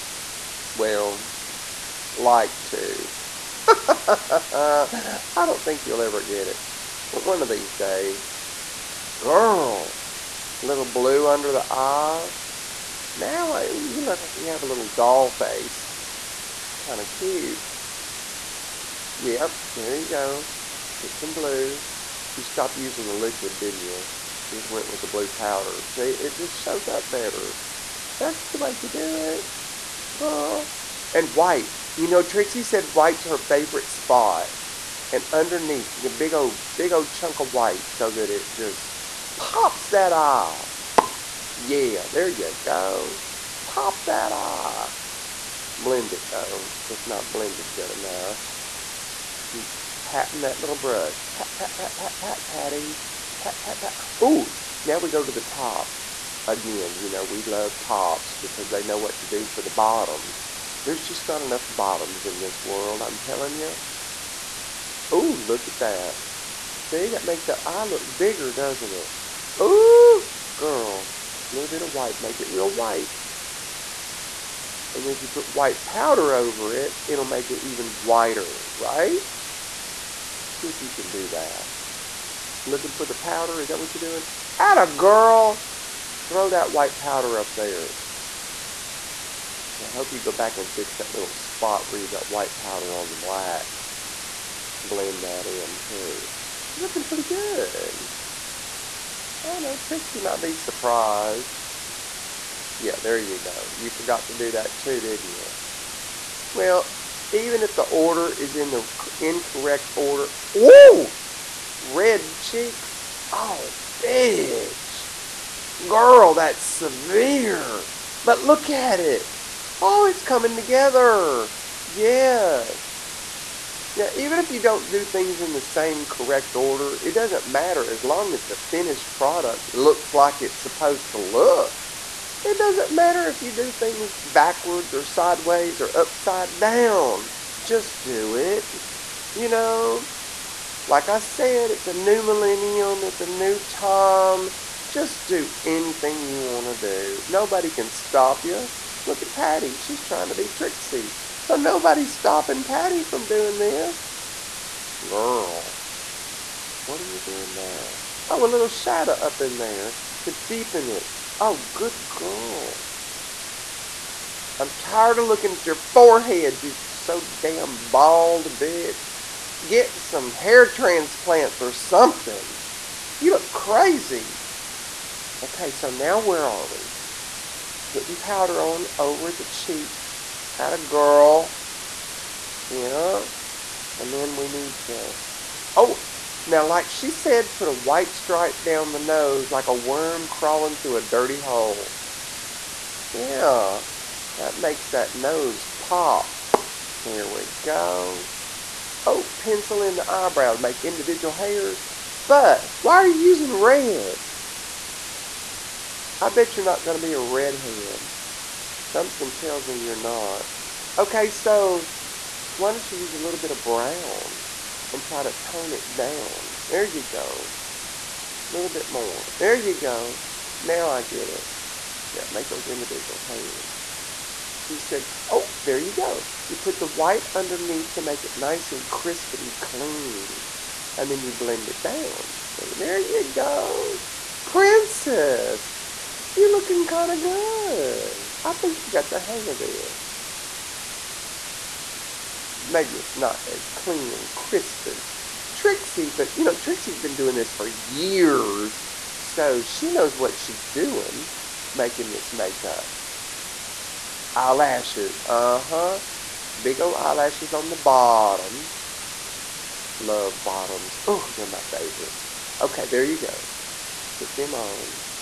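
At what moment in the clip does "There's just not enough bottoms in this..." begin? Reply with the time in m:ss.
1:00.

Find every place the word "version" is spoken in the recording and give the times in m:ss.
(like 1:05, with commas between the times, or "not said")
not said.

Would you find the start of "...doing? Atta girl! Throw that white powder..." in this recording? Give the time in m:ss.
1:24.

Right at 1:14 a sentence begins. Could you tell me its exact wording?
And then if you put white powder over it, it'll make it even whiter, right?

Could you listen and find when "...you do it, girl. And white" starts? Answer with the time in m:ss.
0:28.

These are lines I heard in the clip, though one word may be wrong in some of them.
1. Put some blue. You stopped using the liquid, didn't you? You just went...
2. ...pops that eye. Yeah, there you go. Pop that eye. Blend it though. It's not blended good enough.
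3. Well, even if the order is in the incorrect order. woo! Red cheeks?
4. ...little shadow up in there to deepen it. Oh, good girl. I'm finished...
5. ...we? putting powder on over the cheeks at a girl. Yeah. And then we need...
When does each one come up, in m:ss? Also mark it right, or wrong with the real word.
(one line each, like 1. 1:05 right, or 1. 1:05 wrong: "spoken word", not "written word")
1. 0:21 right
2. 0:39 right
3. 1:46 right
4. 2:38 wrong: "tired", not "finished"
5. 2:56 right.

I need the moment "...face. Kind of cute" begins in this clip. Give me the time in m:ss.
0:15.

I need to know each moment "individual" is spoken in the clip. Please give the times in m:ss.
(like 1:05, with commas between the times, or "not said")
3:20, 3:42.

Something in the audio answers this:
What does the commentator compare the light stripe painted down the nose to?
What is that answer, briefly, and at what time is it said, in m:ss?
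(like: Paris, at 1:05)
a worm, at 3:09.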